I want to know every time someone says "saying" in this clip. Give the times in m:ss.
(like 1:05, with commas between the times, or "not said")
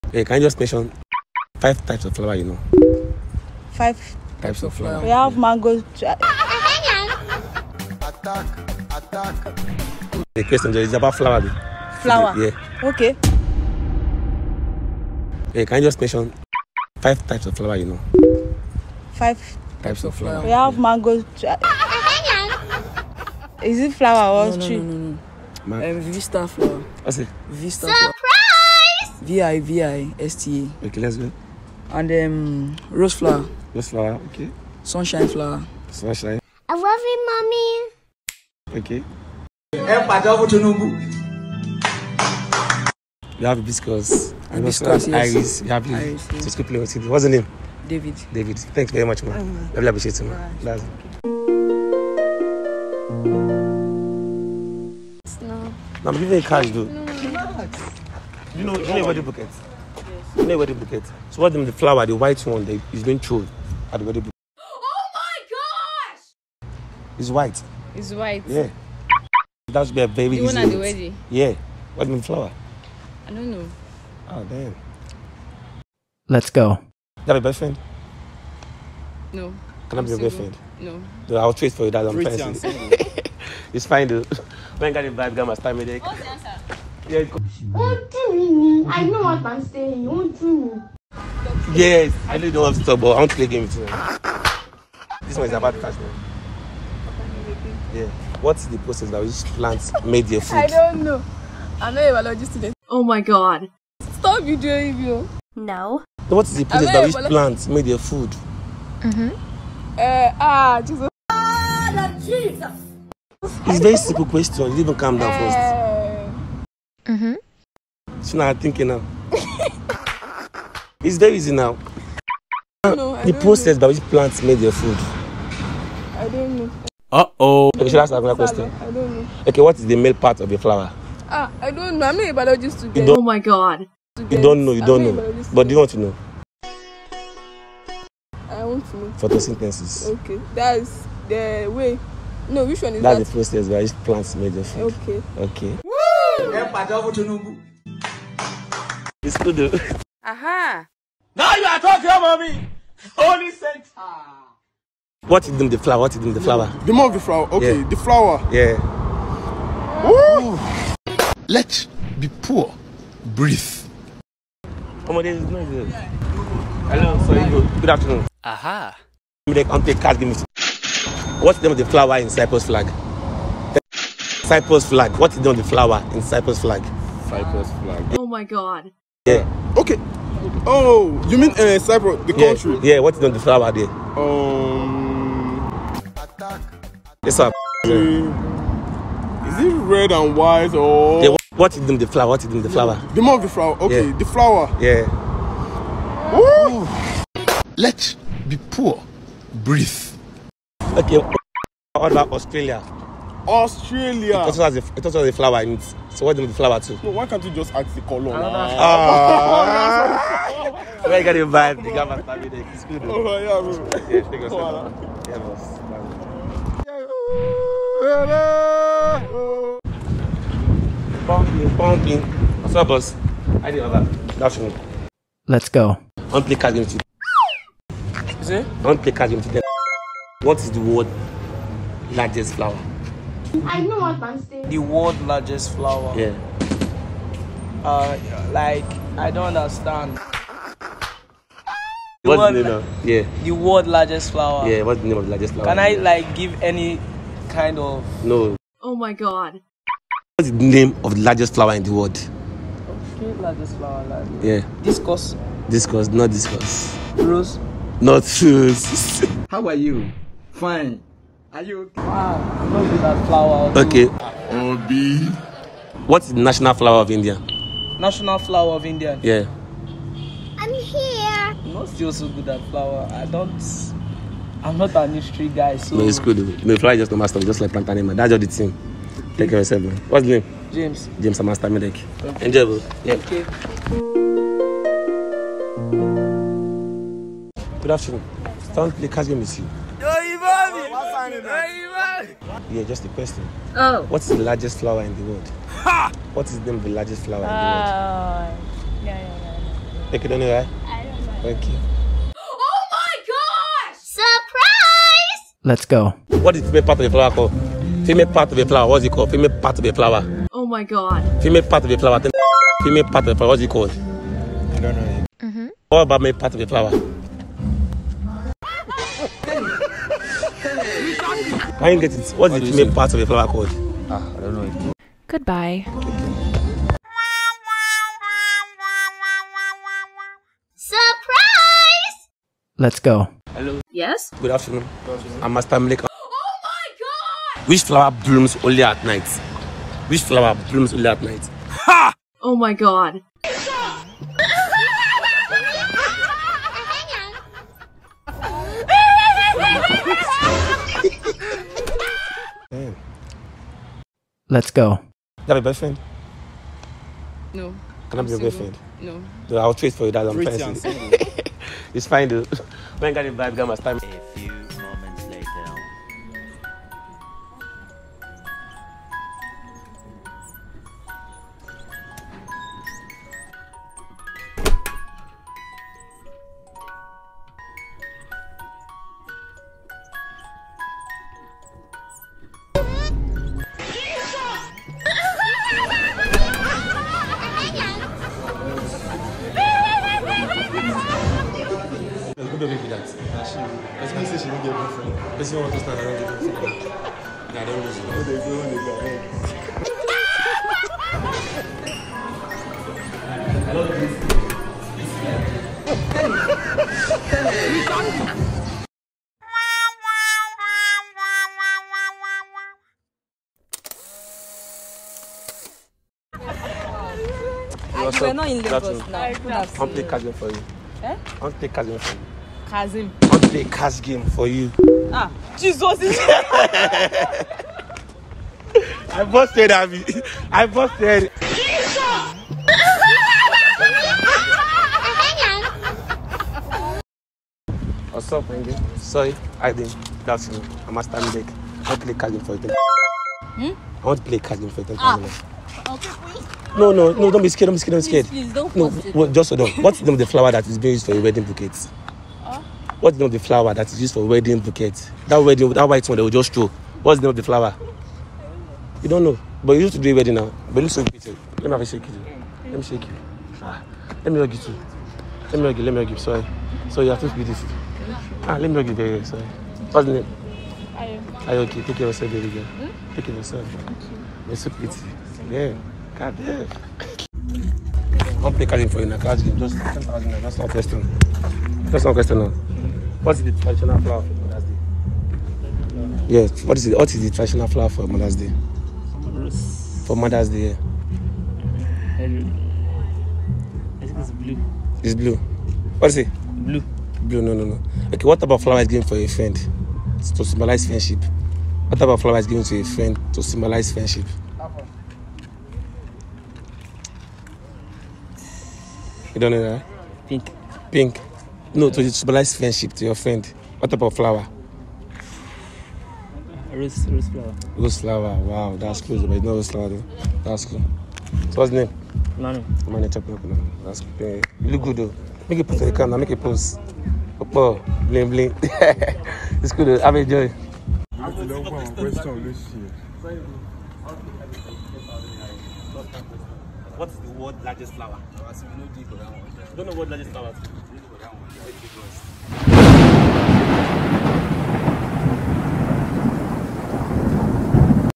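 1:29, 3:54.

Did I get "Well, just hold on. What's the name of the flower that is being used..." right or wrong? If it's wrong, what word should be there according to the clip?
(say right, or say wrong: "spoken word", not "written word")
right.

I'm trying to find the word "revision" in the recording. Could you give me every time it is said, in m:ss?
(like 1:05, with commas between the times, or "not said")
not said.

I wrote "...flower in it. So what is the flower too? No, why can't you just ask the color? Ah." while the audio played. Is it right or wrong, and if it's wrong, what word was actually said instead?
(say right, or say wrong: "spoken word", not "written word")
right.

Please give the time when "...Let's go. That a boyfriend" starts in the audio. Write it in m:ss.
5:54.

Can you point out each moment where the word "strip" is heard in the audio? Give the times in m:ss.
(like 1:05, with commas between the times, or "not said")
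not said.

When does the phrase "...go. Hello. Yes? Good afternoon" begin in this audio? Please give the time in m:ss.
5:32.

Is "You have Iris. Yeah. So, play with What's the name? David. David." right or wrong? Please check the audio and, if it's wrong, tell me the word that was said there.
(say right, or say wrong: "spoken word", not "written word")
right.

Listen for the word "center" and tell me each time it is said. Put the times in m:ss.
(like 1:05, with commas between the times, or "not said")
2:33.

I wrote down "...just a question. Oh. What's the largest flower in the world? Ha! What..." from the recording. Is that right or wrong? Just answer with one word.
right.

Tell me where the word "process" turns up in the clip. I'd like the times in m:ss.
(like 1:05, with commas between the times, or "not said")
1:38, 1:46, 2:03, 2:23.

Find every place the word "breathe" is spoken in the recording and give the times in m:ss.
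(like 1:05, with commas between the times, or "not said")
2:43, 3:19.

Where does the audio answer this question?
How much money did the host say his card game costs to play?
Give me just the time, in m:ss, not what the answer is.
7:59.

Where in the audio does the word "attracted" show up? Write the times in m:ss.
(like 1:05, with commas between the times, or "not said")
not said.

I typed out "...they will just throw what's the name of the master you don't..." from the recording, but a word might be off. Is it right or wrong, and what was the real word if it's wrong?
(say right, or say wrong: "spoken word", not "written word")
wrong: "flower", not "master".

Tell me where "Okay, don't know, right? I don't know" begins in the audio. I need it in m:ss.
5:00.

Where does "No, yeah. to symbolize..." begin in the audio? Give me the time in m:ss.
8:31.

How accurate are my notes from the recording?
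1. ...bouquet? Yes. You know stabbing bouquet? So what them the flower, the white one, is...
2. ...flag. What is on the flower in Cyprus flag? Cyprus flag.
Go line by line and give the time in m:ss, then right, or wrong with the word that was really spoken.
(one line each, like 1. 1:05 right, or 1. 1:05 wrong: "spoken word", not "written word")
1. 0:59 wrong: "wedding", not "stabbing"
2. 2:54 right.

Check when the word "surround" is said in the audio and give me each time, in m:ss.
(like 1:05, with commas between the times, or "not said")
not said.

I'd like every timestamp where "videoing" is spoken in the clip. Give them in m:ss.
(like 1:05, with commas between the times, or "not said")
1:44.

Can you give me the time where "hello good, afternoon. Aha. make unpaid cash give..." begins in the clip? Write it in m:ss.
2:46.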